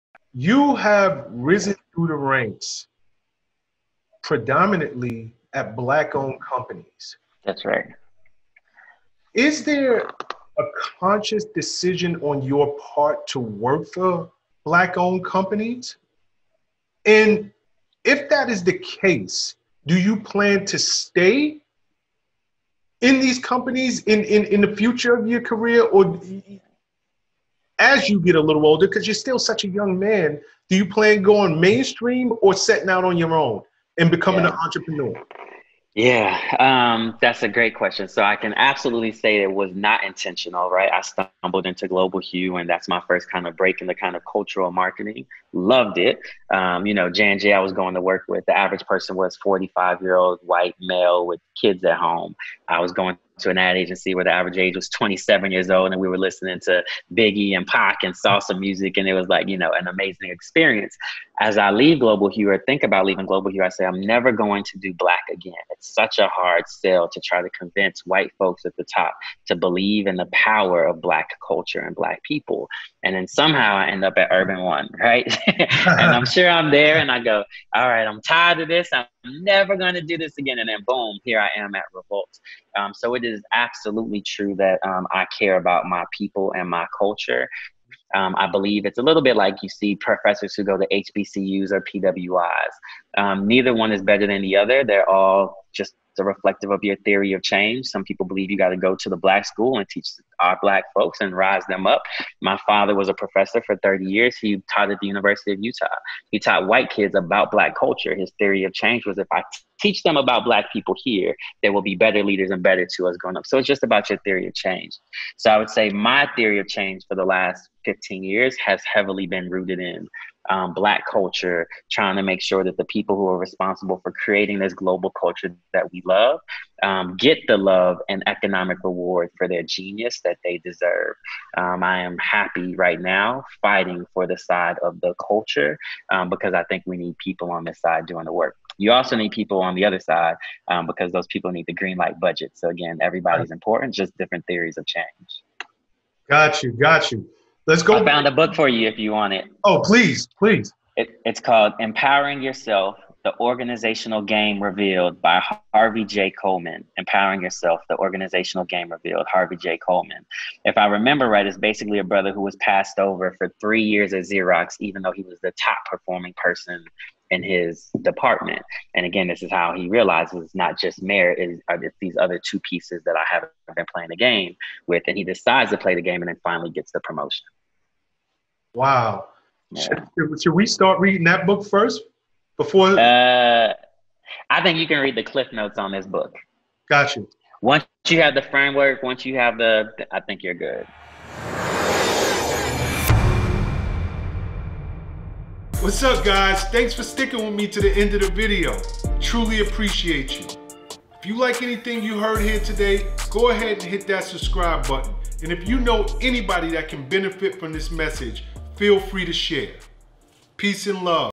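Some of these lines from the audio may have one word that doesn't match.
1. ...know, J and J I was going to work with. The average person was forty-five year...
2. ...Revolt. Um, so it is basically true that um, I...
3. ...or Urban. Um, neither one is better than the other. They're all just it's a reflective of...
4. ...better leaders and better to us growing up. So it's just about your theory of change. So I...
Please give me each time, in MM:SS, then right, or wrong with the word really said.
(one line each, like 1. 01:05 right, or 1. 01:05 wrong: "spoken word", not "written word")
1. 00:46 right
2. 01:21 wrong: "absolutely", not "basically"
3. 01:31 wrong: "PWIs", not "Urban"
4. 01:51 right.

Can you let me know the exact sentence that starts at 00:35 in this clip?
Yeah, um, that's a great question.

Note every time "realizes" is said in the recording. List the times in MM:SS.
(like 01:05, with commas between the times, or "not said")
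02:49.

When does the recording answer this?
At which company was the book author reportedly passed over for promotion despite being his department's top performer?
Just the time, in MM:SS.
02:44.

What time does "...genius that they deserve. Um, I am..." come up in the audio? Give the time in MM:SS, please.
02:09.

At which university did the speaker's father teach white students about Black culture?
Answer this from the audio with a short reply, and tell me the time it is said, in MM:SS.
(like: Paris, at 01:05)
University of Utah, at 01:45.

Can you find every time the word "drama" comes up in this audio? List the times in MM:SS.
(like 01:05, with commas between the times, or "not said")
not said.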